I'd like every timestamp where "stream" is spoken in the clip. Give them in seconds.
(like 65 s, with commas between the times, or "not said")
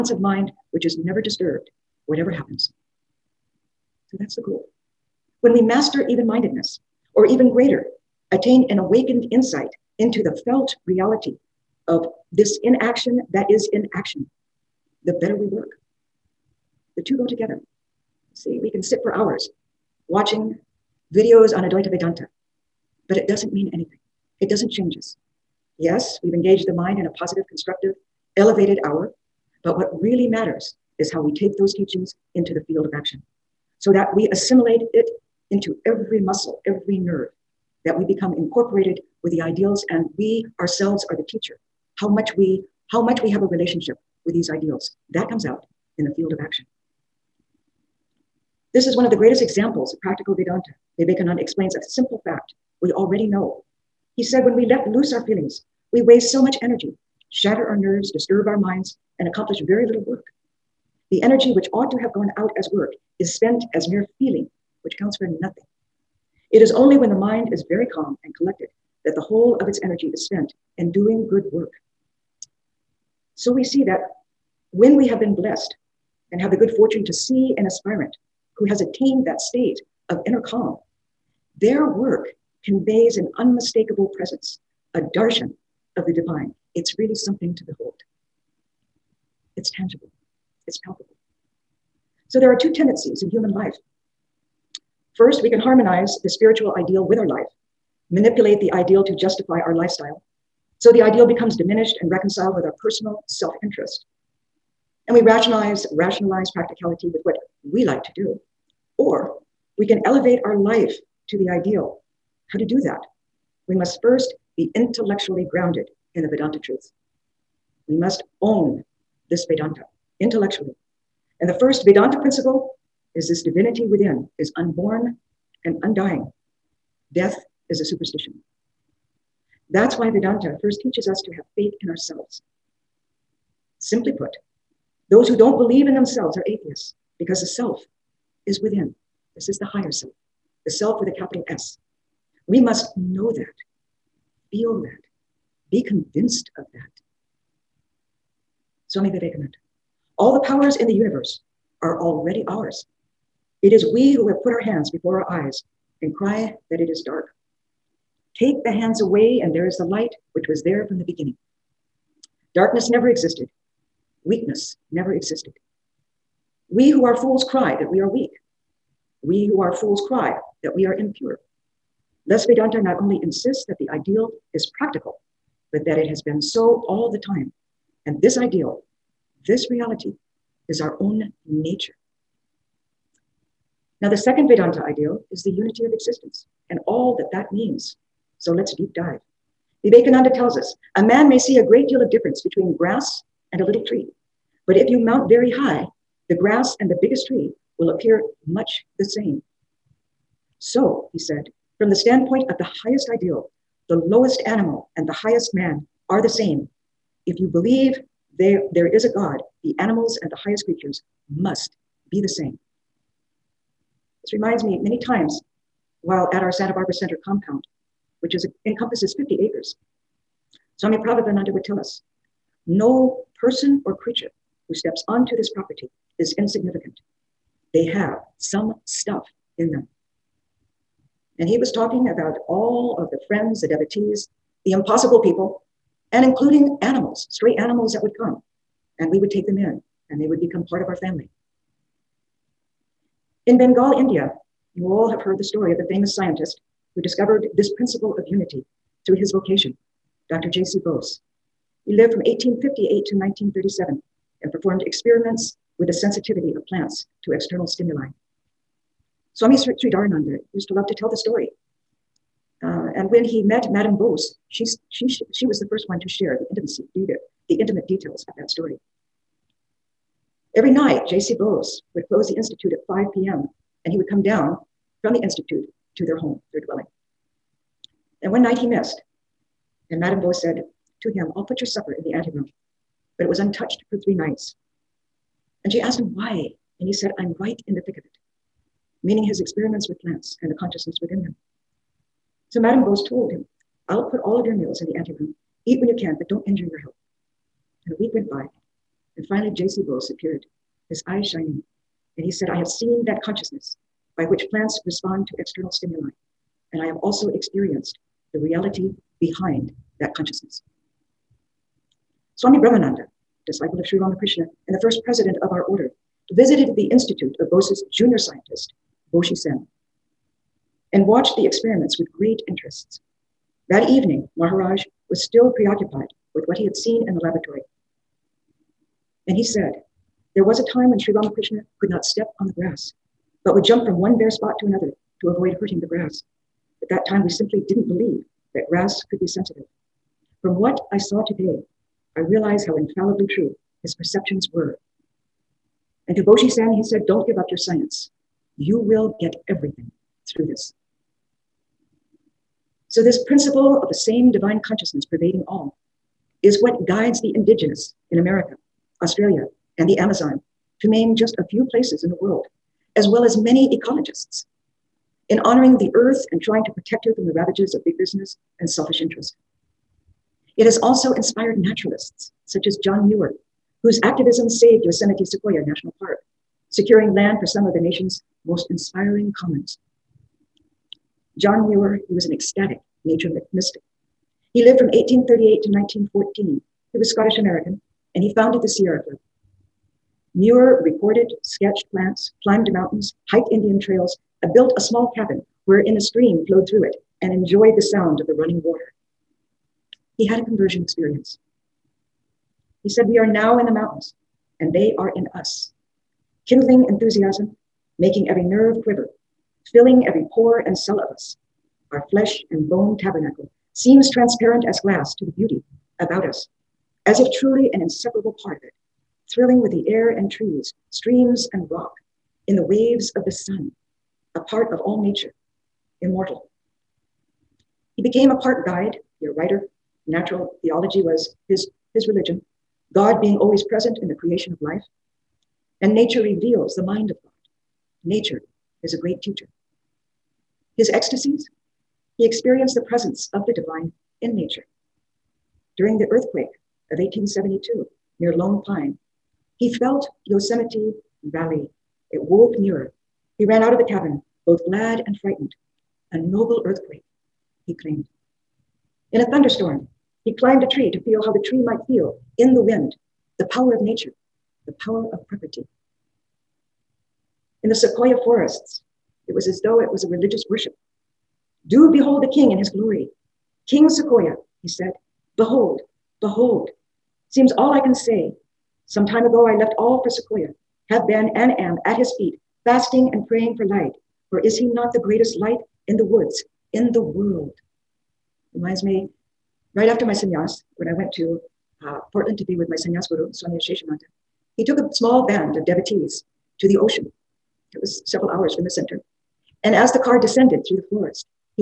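395 s, 420 s.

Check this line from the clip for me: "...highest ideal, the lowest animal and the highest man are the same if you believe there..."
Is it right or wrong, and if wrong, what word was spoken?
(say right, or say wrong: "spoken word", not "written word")
right.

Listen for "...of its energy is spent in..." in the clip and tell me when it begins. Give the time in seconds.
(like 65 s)
69 s.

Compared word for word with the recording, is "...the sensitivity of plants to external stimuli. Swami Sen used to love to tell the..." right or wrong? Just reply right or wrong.
wrong.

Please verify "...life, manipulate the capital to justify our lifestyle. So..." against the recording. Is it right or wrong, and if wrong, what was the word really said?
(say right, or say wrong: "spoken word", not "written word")
wrong: "ideal", not "capital".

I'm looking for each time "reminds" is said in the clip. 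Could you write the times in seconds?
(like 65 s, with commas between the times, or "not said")
214 s, 488 s.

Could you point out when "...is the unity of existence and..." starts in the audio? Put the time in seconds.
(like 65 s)
185 s.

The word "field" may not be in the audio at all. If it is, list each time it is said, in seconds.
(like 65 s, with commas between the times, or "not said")
32 s, 46 s.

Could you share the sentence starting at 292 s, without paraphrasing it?
So Madame Bose told him, I'll put all of your meals in the anteroom.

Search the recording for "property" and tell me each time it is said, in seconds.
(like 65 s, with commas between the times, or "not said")
225 s, 465 s.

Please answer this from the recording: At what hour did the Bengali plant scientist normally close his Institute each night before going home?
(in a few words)
5 p.m.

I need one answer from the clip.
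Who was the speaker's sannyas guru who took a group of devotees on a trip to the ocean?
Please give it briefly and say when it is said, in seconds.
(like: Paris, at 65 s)
Swami Aseshananda, at 493 s.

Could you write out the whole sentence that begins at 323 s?
That evening, Maharaj was still preoccupied with what he had seen in the laboratory.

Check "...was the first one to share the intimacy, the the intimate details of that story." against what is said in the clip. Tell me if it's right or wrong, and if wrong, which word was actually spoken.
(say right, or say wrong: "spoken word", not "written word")
right.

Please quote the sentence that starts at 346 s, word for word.
And to Boshi Sen, he said, Don't give up your science.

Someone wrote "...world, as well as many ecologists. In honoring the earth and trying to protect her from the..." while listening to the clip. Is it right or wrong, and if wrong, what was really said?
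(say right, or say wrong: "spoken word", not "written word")
right.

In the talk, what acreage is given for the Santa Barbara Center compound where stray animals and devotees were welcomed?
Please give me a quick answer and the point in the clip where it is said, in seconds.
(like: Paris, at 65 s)
50 acres, at 219 s.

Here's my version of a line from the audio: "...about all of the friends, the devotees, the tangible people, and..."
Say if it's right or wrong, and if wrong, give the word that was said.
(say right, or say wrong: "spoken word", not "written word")
wrong: "impossible", not "tangible".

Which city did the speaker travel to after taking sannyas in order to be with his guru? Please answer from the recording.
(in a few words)
Portland.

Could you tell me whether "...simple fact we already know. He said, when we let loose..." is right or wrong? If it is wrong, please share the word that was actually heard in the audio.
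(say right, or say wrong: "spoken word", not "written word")
right.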